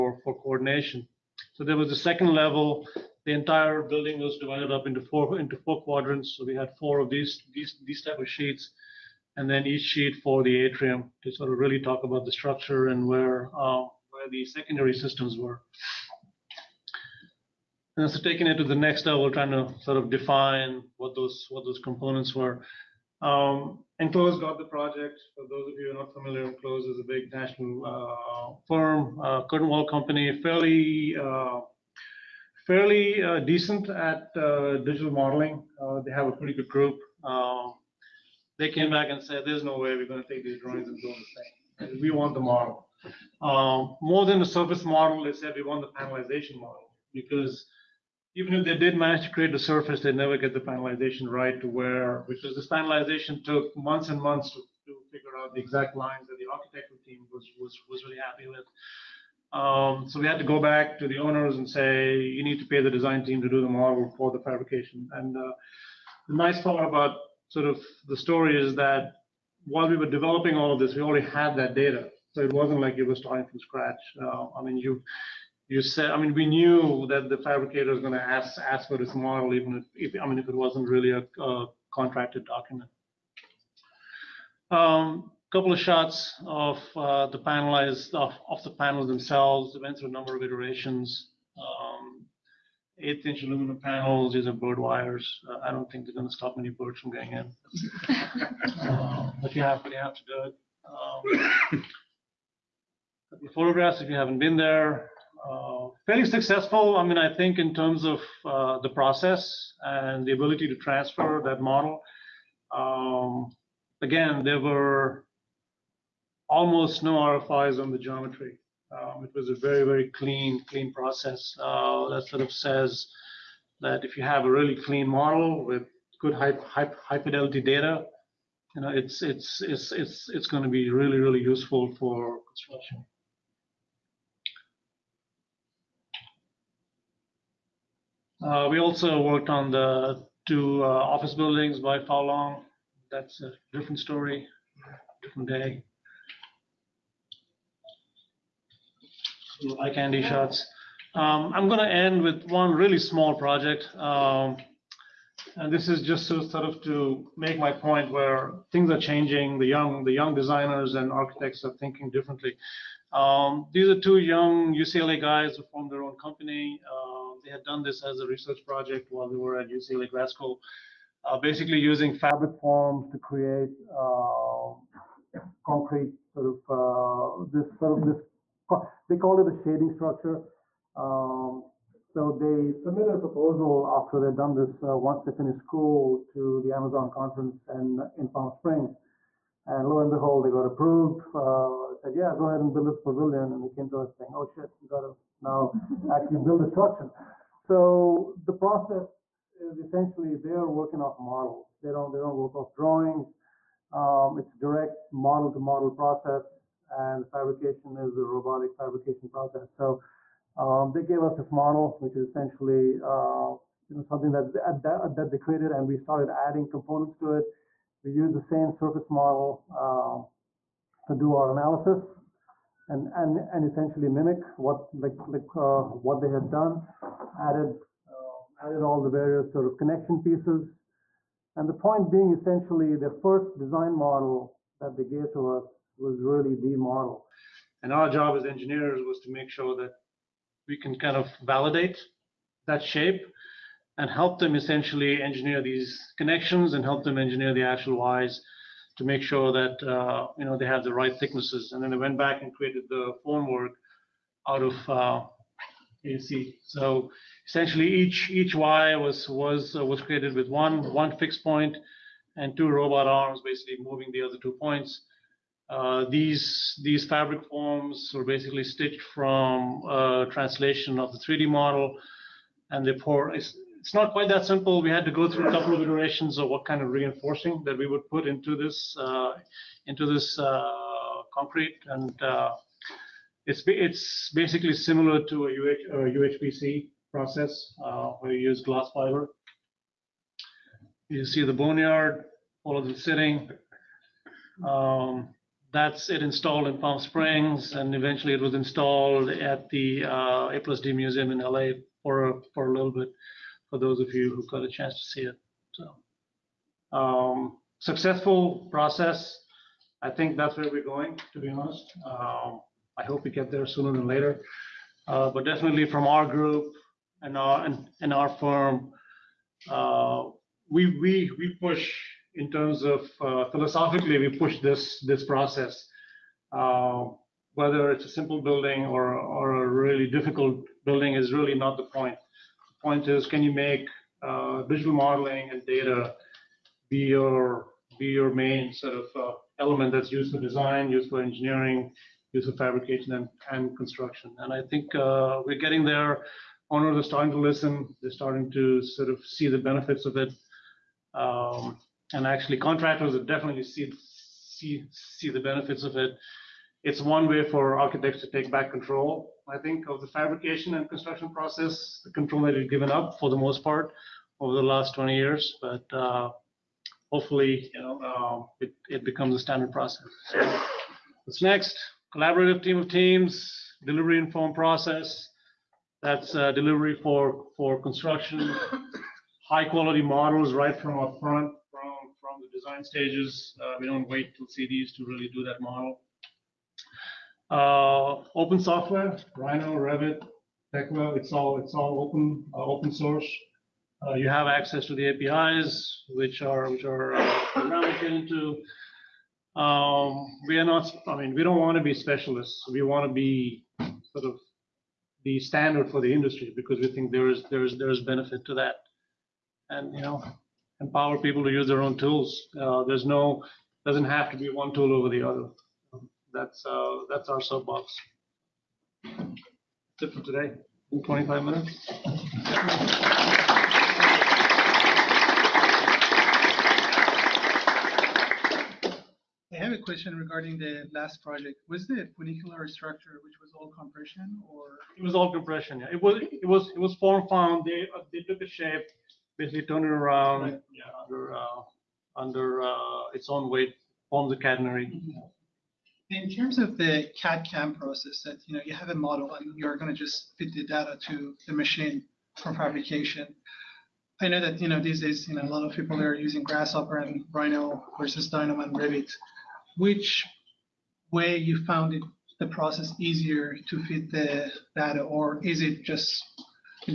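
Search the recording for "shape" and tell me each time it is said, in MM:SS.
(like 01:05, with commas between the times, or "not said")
04:02, 07:18.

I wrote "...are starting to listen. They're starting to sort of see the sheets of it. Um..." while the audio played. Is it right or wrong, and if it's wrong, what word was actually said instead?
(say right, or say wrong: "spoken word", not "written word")
wrong: "benefits", not "sheets".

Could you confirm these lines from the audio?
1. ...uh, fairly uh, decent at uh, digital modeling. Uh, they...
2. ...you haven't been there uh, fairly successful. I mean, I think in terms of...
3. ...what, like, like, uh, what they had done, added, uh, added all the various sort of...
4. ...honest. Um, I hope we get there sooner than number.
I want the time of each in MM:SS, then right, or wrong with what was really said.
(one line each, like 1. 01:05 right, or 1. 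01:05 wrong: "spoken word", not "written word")
1. 00:31 right
2. 01:44 right
3. 03:44 right
4. 05:11 wrong: "later", not "number".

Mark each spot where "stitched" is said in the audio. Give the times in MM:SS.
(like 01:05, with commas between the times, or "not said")
04:28.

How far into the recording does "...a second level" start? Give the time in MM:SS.
00:01.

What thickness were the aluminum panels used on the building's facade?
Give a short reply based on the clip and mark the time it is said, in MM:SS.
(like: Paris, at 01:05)
1/8 inch, at 01:32.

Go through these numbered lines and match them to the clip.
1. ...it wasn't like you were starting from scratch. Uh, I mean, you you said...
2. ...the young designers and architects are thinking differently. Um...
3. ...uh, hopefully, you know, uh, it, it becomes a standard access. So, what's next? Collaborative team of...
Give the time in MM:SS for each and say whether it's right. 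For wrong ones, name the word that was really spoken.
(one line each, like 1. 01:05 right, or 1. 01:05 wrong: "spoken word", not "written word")
1. 01:12 right
2. 02:40 right
3. 06:05 wrong: "process", not "access".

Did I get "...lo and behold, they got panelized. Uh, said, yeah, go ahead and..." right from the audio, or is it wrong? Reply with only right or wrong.
wrong.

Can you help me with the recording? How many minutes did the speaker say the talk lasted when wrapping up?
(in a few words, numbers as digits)
25.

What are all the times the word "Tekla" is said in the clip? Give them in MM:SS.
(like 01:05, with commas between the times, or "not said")
06:30.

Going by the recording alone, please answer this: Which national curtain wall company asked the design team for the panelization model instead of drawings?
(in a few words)
Enclos.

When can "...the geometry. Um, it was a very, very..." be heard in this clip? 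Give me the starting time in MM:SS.
01:57.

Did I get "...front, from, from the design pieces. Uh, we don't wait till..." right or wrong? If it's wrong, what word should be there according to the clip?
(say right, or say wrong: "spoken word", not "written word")
wrong: "stages", not "pieces".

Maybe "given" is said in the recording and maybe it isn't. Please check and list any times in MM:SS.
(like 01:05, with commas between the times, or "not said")
06:02.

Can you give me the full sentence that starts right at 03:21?
They don't they don't work off drawings.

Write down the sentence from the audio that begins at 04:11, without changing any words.
And then they went back and created the formwork out of uh, AC.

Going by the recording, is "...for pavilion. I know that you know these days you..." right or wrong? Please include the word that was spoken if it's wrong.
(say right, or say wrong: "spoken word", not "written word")
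wrong: "fabrication", not "pavilion".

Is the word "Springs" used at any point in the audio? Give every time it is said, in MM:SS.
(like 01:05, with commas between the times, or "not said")
03:08, 04:56.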